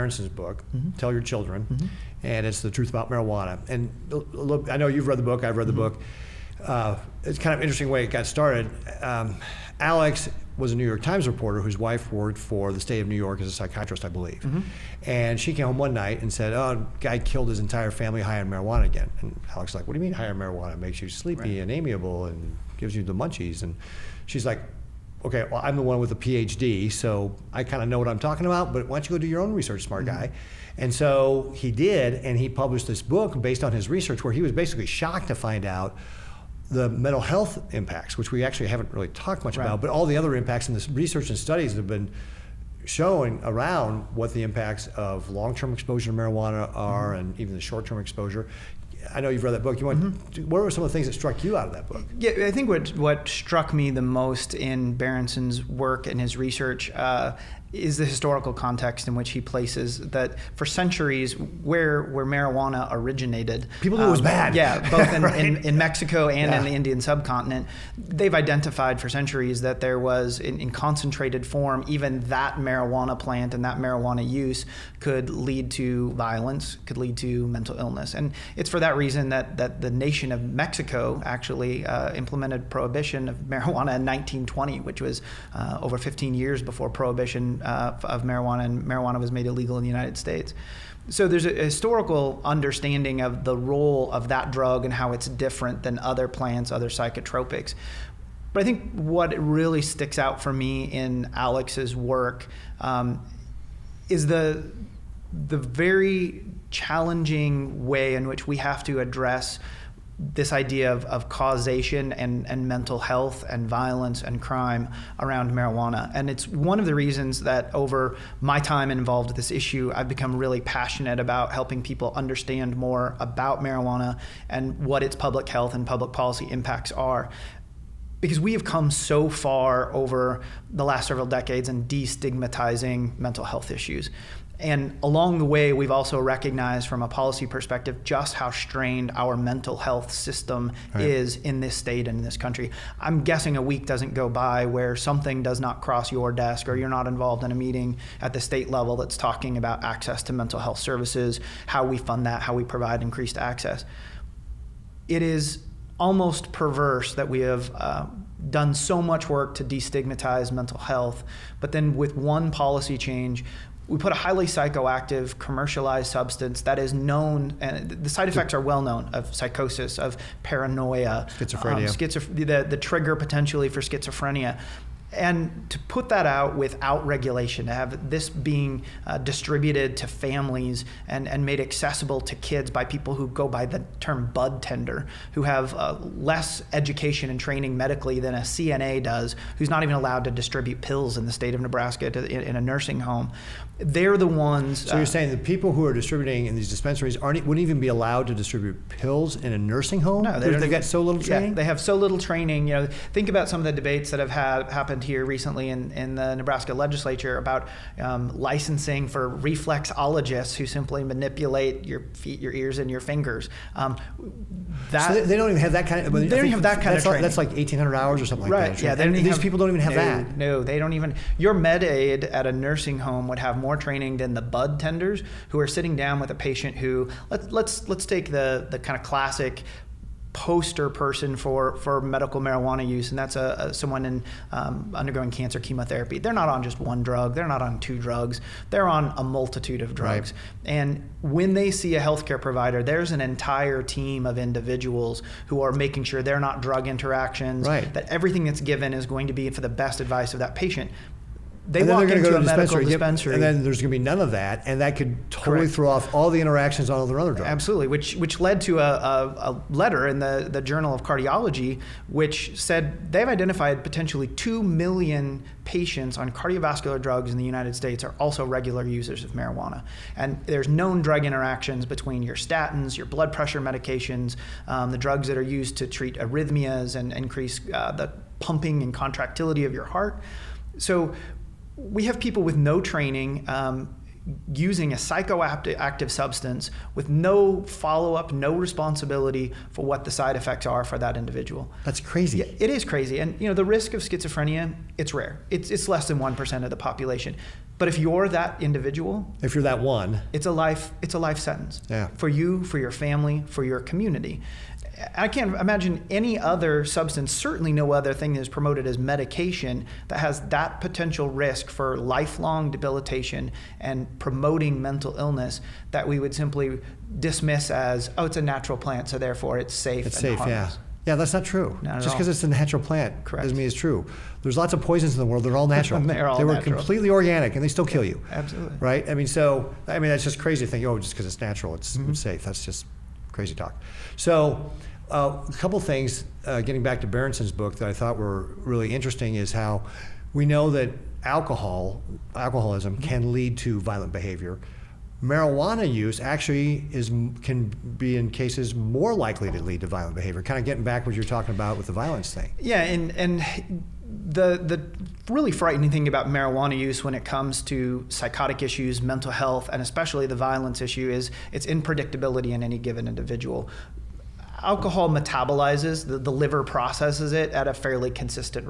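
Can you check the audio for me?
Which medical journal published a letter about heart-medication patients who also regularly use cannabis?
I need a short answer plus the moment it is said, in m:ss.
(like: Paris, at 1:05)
Journal of Cardiology, at 4:20.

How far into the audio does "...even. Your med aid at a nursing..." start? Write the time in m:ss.
3:40.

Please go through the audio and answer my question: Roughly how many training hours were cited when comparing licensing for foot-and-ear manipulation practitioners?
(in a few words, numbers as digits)
1,800 hours.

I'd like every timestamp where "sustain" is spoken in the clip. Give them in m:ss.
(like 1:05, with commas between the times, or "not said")
not said.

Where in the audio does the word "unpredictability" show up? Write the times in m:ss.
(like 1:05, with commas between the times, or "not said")
6:01.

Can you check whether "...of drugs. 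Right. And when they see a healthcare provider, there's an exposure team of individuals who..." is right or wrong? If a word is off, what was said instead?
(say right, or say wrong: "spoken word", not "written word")
wrong: "entire", not "exposure".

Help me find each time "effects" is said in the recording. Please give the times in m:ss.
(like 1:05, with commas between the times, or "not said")
2:48, 4:50.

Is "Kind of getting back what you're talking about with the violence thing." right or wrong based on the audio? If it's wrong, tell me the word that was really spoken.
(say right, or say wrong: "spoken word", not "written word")
right.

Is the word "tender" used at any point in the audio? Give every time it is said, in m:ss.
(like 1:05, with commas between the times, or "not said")
3:04, 3:44.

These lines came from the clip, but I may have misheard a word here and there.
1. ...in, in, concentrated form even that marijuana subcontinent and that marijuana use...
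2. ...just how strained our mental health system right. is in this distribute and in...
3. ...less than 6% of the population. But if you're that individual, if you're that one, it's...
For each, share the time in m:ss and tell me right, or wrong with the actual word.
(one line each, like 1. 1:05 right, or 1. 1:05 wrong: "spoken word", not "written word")
1. 1:10 wrong: "plant", not "subcontinent"
2. 2:18 wrong: "state", not "distribute"
3. 4:55 wrong: "1", not "6".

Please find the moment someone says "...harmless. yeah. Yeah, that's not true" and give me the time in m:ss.
5:20.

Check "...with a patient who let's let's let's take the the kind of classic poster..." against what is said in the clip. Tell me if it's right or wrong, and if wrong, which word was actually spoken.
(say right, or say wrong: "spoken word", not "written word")
right.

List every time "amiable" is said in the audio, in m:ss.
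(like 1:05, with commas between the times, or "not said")
0:21.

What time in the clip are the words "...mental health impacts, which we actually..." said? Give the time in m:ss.
0:36.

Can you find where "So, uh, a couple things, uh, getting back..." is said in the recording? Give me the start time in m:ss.
5:34.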